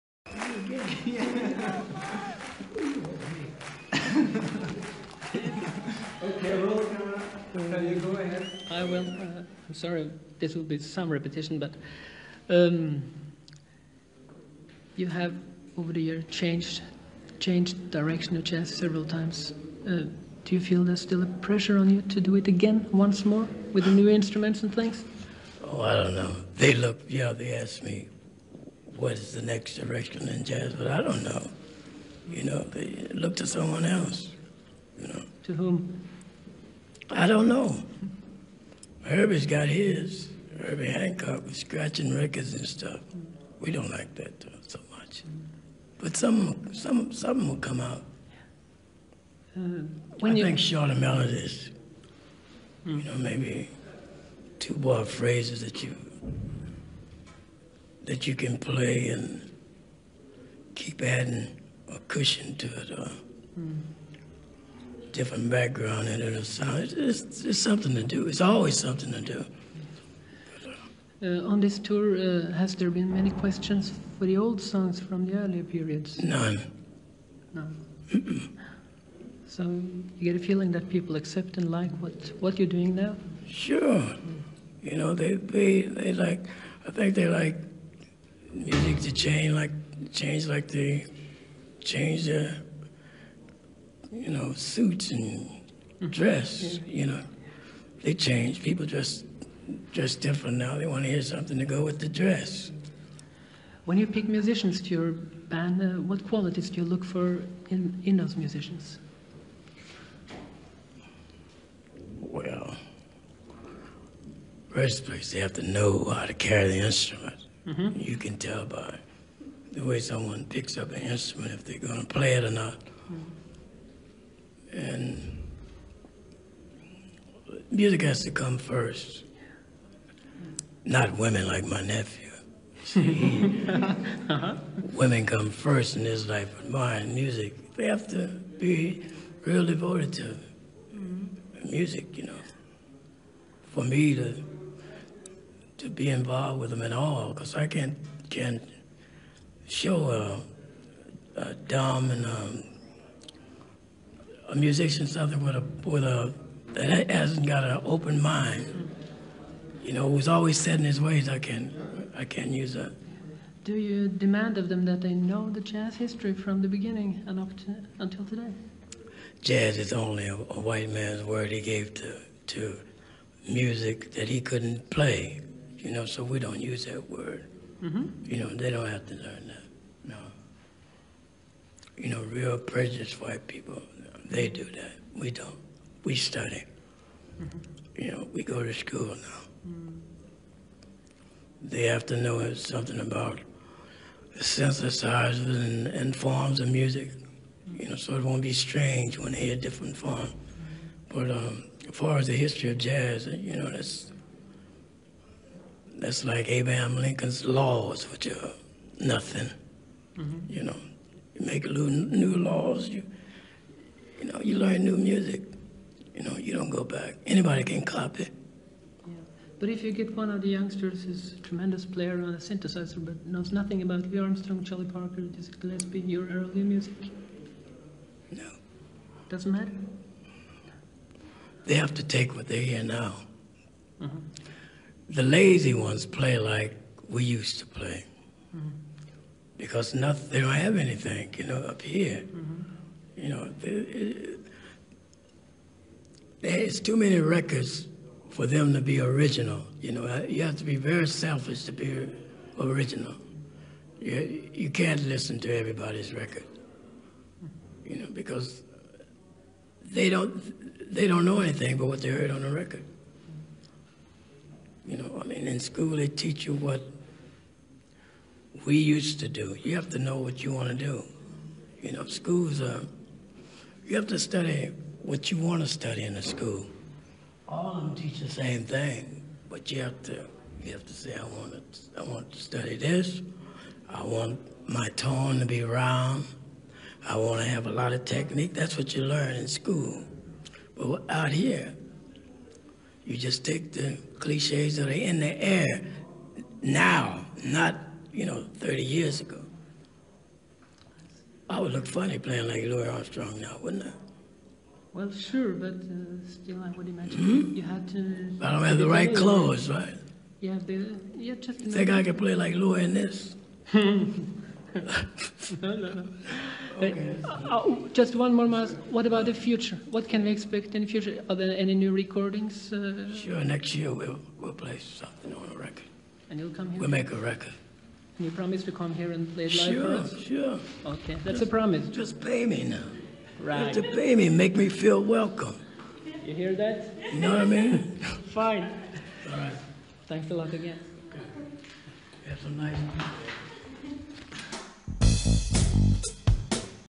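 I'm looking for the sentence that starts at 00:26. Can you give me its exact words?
They look, yeah, they asked me what is the next direction in jazz, but I don't know.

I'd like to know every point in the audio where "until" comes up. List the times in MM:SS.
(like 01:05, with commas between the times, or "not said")
02:47.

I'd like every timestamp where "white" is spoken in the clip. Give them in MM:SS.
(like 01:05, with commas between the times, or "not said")
02:50, 03:03.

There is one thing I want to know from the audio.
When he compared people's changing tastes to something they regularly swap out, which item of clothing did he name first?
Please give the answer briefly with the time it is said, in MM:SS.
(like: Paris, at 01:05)
suits, at 01:34.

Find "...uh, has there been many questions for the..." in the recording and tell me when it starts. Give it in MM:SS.
01:12.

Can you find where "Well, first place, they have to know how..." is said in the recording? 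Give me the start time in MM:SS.
01:52.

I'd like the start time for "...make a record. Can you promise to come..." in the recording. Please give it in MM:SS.
05:26.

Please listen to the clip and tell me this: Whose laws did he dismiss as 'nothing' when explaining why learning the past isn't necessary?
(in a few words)
Abraham Lincoln's.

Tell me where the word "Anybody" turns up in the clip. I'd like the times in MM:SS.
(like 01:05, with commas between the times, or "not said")
03:37.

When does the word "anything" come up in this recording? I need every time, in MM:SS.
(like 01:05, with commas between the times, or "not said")
04:00, 04:21.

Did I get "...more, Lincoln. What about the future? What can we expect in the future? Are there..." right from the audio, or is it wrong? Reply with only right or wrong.
wrong.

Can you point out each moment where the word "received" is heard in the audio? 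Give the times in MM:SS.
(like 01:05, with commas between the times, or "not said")
not said.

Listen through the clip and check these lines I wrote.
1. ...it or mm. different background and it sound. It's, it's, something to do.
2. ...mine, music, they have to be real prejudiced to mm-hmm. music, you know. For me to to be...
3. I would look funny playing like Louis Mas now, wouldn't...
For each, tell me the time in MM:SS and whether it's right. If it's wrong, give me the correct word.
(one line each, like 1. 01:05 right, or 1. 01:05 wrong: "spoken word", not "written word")
1. 01:02 right
2. 02:16 wrong: "devoted", not "prejudiced"
3. 05:01 wrong: "Armstrong", not "Mas".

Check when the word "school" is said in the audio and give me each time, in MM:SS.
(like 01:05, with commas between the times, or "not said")
03:08, 04:25, 04:32, 04:36, 04:49.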